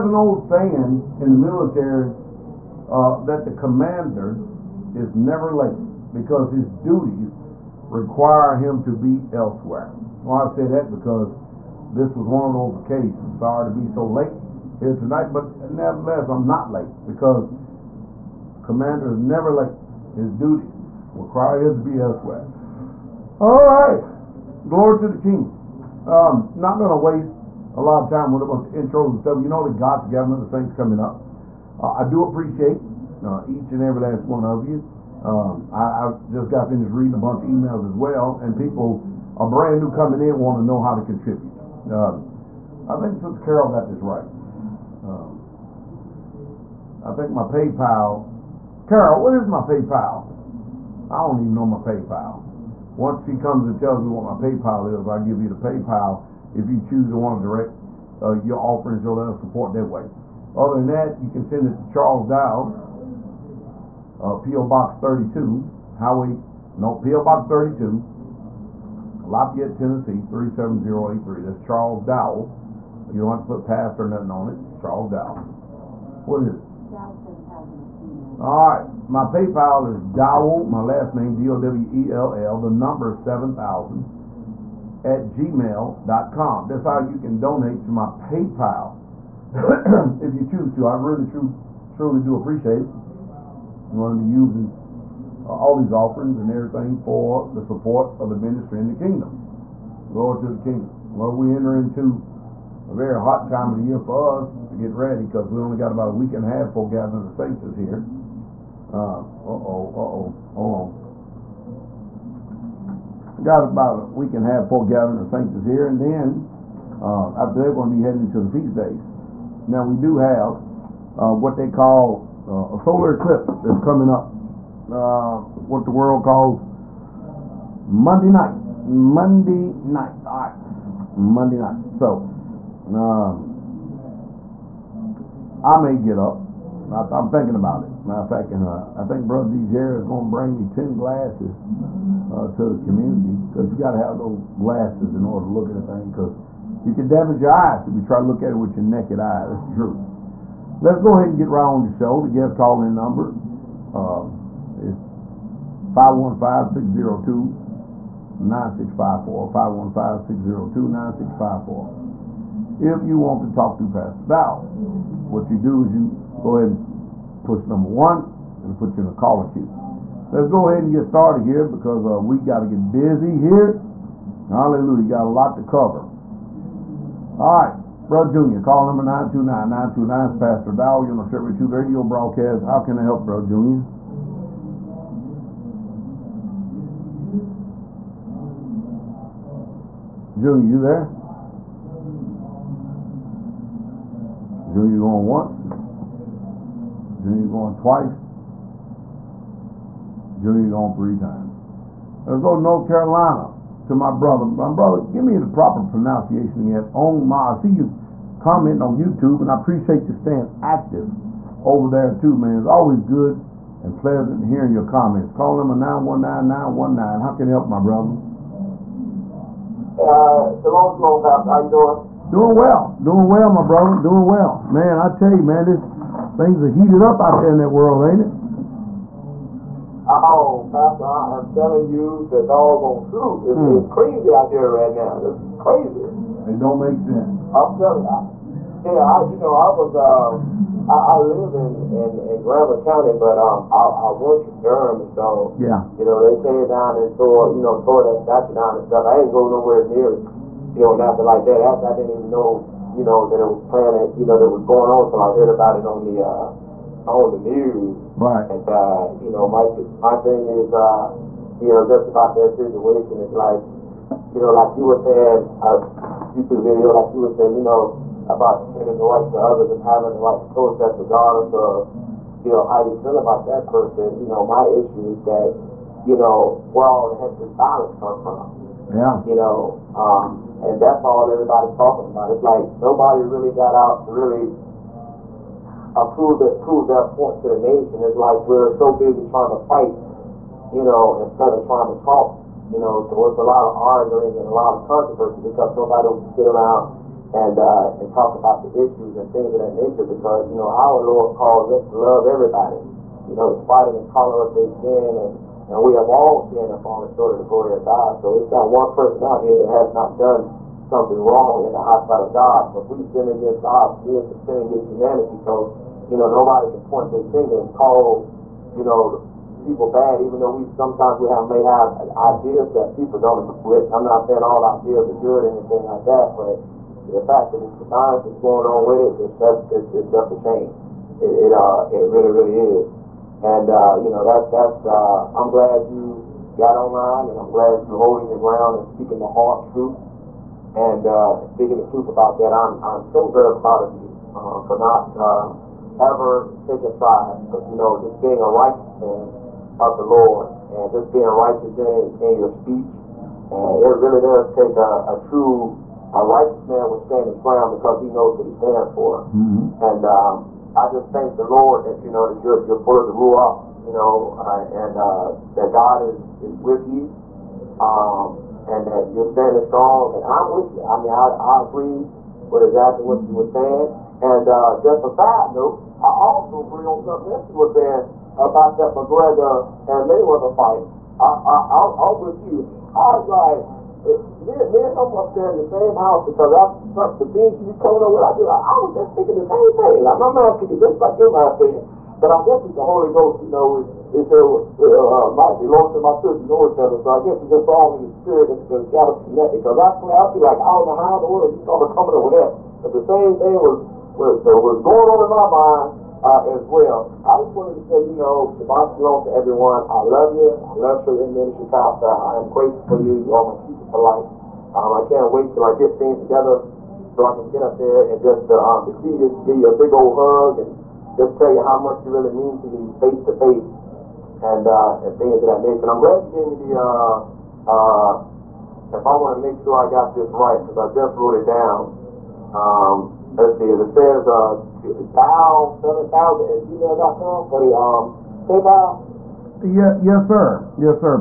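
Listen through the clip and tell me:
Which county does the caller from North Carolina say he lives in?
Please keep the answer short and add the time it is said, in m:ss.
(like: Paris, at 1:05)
Granville County, at 4:02.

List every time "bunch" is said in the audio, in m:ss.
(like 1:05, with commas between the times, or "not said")
0:28, 0:37.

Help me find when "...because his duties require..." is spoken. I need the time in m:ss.
0:06.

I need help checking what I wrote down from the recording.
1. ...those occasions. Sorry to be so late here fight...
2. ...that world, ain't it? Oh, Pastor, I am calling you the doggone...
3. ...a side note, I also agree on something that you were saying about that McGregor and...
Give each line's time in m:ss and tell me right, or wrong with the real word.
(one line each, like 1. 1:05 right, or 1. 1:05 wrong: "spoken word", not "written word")
1. 0:12 wrong: "tonight", not "fight"
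2. 3:47 wrong: "telling", not "calling"
3. 6:15 right.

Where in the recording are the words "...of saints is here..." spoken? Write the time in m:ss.
1:55.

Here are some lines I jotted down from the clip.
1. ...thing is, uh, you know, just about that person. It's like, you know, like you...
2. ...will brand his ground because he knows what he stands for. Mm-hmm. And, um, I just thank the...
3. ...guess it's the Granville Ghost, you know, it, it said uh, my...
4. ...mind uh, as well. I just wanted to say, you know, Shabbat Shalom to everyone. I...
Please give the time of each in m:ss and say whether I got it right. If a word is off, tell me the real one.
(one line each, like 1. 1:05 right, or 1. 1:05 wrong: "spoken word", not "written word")
1. 4:20 wrong: "situation", not "person"
2. 5:56 wrong: "stand", not "brand"
3. 6:32 wrong: "Holy", not "Granville"
4. 6:45 right.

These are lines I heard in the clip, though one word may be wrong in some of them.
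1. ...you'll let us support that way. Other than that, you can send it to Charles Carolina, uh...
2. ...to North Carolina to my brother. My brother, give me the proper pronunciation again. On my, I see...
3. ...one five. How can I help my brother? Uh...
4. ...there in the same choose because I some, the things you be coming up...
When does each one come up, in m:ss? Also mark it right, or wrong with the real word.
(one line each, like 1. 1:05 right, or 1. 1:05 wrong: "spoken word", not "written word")
1. 0:59 wrong: "Dow", not "Carolina"
2. 3:22 right
3. 3:36 wrong: "nine", not "five"
4. 6:25 wrong: "house", not "choose".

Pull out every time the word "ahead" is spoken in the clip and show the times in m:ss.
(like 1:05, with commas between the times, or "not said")
2:31, 2:46, 2:50.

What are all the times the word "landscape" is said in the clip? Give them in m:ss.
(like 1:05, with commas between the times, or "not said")
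not said.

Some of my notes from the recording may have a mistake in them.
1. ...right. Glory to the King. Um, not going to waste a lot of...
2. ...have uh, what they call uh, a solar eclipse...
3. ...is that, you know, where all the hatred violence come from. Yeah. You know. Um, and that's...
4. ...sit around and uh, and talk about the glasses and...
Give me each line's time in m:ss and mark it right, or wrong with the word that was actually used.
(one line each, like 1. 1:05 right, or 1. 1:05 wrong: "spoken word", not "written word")
1. 0:23 right
2. 2:00 right
3. 4:35 right
4. 4:56 wrong: "issues", not "glasses".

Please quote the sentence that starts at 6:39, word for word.
Because I play, I be like, I was not know how in the world you started coming up with that.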